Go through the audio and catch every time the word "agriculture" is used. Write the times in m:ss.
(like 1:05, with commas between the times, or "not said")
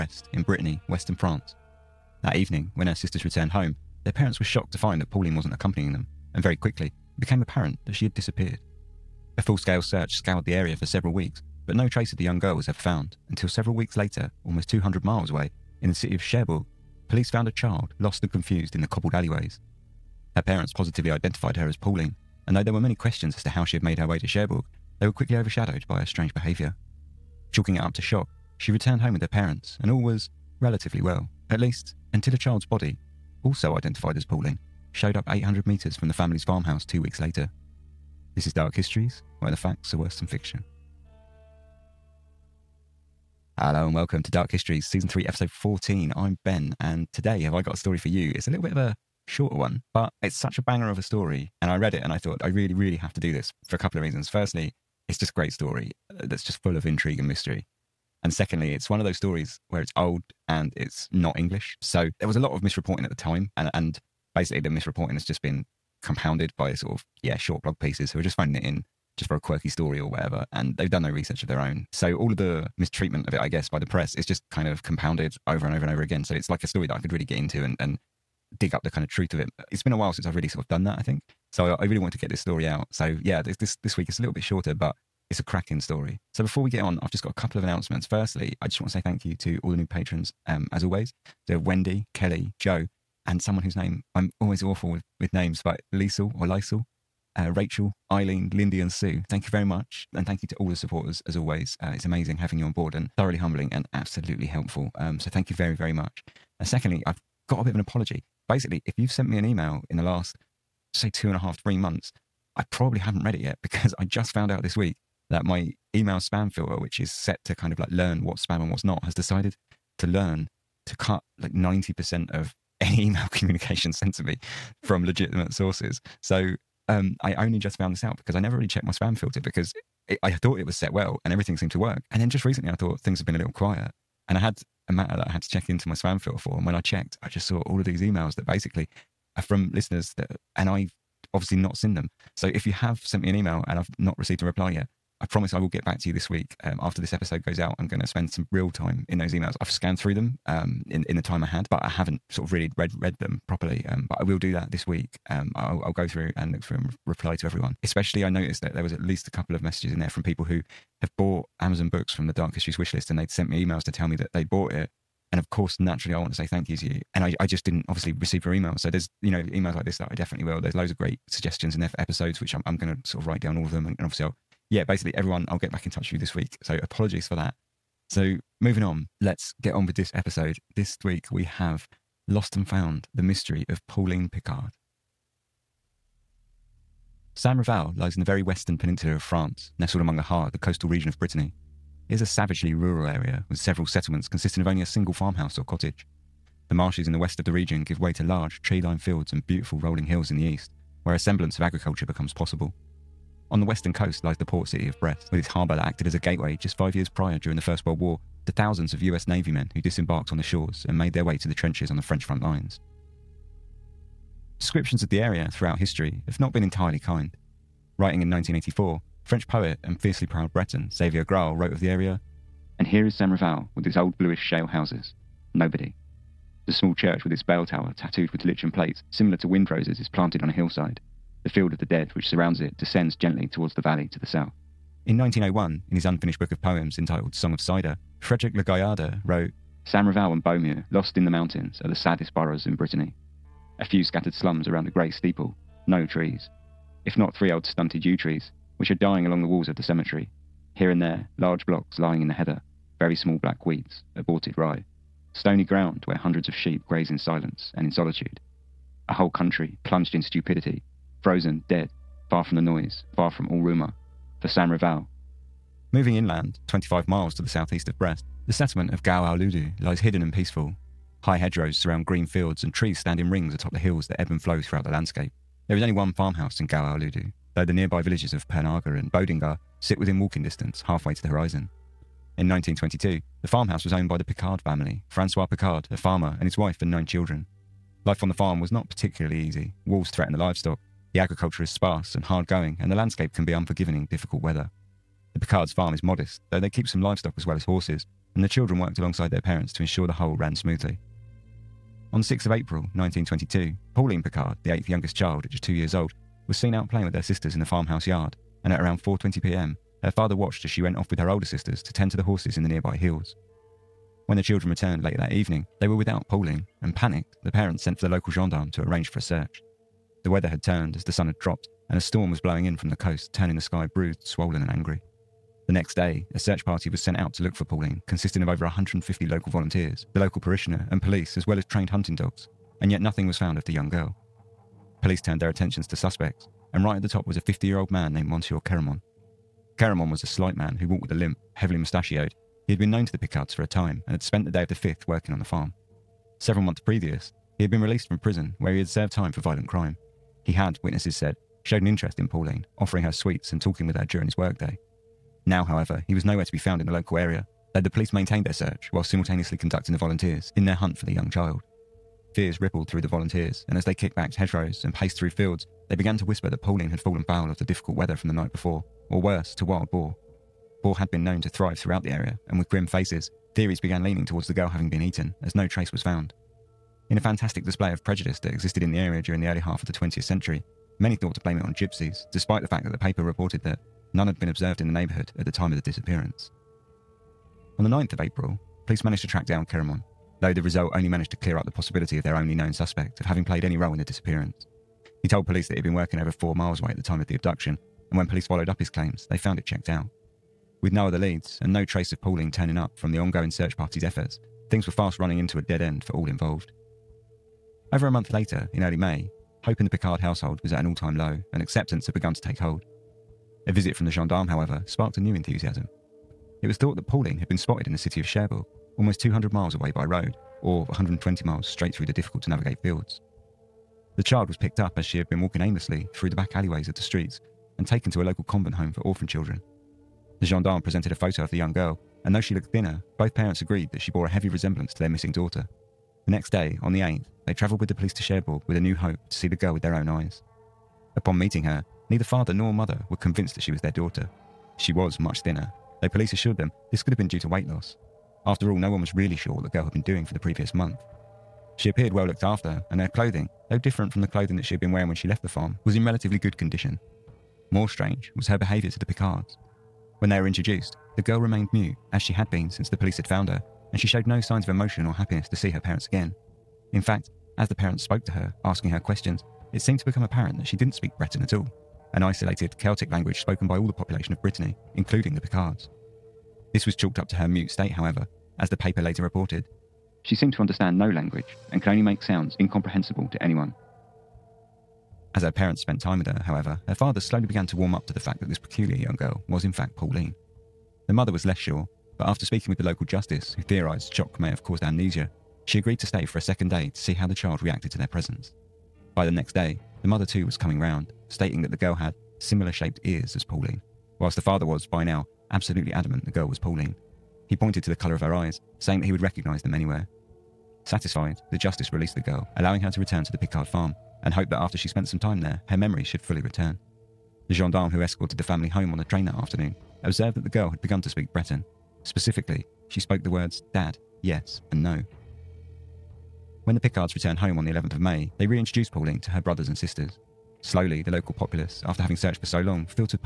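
3:21, 4:51.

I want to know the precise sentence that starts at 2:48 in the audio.
So there's, you know, emails like this that I definitely will.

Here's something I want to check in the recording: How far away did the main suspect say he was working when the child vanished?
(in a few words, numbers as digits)
4 miles.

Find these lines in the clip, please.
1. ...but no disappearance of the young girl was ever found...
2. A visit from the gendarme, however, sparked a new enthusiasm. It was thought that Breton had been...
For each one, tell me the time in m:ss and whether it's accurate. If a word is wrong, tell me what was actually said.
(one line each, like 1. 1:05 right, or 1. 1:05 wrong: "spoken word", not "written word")
1. 0:11 wrong: "trace", not "disappearance"
2. 6:53 wrong: "Pauline", not "Breton".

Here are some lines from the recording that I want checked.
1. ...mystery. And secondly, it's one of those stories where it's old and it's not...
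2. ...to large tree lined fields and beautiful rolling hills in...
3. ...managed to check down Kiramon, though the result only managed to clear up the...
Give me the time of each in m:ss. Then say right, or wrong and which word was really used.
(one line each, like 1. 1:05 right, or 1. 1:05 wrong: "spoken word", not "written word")
1. 0:57 right
2. 3:18 right
3. 6:29 wrong: "track", not "check".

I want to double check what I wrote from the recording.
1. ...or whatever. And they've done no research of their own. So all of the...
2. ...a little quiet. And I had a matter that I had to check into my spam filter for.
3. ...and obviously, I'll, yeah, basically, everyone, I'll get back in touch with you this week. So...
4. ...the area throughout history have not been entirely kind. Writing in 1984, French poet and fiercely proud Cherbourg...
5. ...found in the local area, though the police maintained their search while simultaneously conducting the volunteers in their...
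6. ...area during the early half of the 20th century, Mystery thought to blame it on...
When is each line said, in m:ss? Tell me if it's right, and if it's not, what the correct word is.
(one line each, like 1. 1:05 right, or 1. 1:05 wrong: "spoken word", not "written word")
1. 1:09 right
2. 2:13 right
3. 2:53 right
4. 3:35 wrong: "Breton", not "Cherbourg"
5. 5:56 right
6. 6:18 wrong: "Many", not "Mystery".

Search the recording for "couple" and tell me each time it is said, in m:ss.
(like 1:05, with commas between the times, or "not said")
0:53, 1:27, 2:39.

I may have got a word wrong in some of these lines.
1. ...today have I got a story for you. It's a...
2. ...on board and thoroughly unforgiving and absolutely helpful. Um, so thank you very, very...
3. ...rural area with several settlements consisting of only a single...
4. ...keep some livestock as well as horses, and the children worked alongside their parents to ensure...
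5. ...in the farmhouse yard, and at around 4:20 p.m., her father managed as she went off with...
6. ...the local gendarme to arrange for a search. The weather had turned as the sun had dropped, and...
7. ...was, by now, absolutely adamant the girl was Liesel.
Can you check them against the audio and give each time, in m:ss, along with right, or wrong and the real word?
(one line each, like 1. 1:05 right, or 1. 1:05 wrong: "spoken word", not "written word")
1. 0:47 right
2. 1:42 wrong: "humbling", not "unforgiving"
3. 3:12 right
4. 4:56 right
5. 5:07 wrong: "watched", not "managed"
6. 5:18 right
7. 8:24 wrong: "Pauline", not "Liesel".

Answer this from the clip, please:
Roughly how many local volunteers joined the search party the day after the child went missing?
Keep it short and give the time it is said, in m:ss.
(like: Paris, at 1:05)
150, at 5:28.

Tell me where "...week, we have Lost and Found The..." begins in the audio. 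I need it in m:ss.
3:01.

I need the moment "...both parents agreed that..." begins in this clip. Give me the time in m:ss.
7:13.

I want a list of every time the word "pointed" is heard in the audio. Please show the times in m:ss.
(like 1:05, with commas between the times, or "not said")
8:27.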